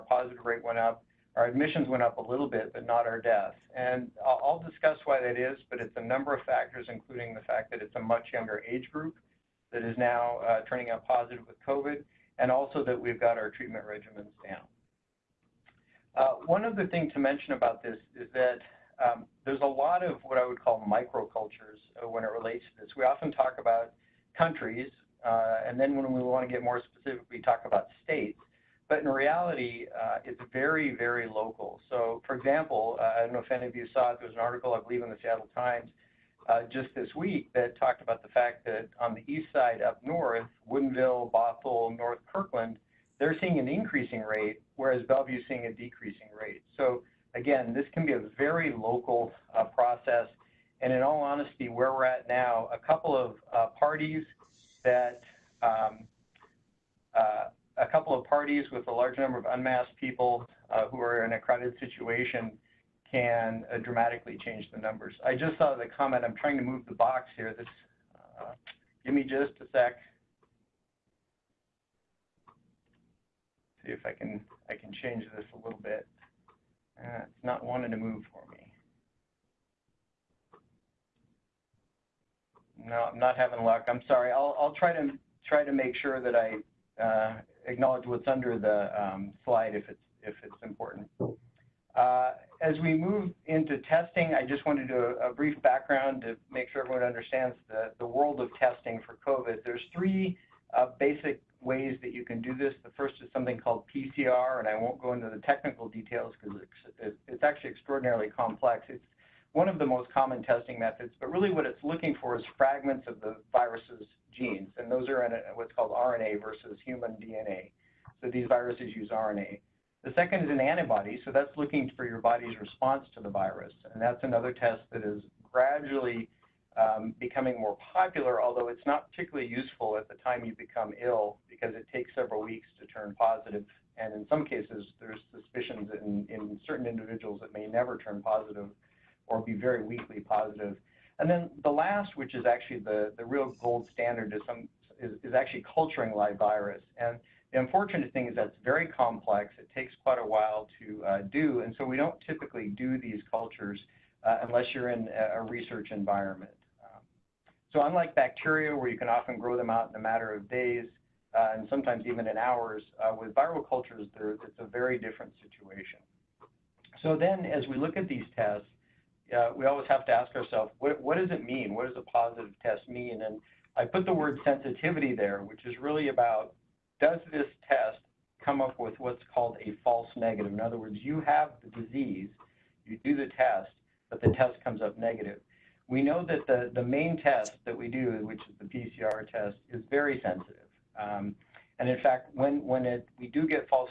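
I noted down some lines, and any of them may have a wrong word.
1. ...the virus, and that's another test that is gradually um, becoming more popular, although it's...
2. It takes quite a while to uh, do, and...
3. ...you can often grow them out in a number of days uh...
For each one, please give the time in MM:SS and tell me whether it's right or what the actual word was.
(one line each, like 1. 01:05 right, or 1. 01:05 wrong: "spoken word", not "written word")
1. 02:03 right
2. 02:29 right
3. 02:38 wrong: "matter", not "number".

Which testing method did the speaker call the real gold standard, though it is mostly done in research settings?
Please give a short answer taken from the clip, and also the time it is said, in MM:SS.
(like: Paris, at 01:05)
culturing live virus, at 02:25.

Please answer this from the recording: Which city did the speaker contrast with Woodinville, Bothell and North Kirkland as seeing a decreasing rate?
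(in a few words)
Bellevue.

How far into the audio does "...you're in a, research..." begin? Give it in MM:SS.
02:34.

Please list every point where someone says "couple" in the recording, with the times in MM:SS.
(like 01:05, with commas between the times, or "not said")
00:52, 00:57.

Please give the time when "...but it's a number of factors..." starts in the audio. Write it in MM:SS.
00:05.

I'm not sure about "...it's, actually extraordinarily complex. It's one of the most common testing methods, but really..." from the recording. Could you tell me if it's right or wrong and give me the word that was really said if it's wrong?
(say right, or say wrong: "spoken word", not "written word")
right.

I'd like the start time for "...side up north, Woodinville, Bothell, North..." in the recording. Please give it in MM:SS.
00:39.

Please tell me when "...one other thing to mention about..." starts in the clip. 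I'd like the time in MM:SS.
00:16.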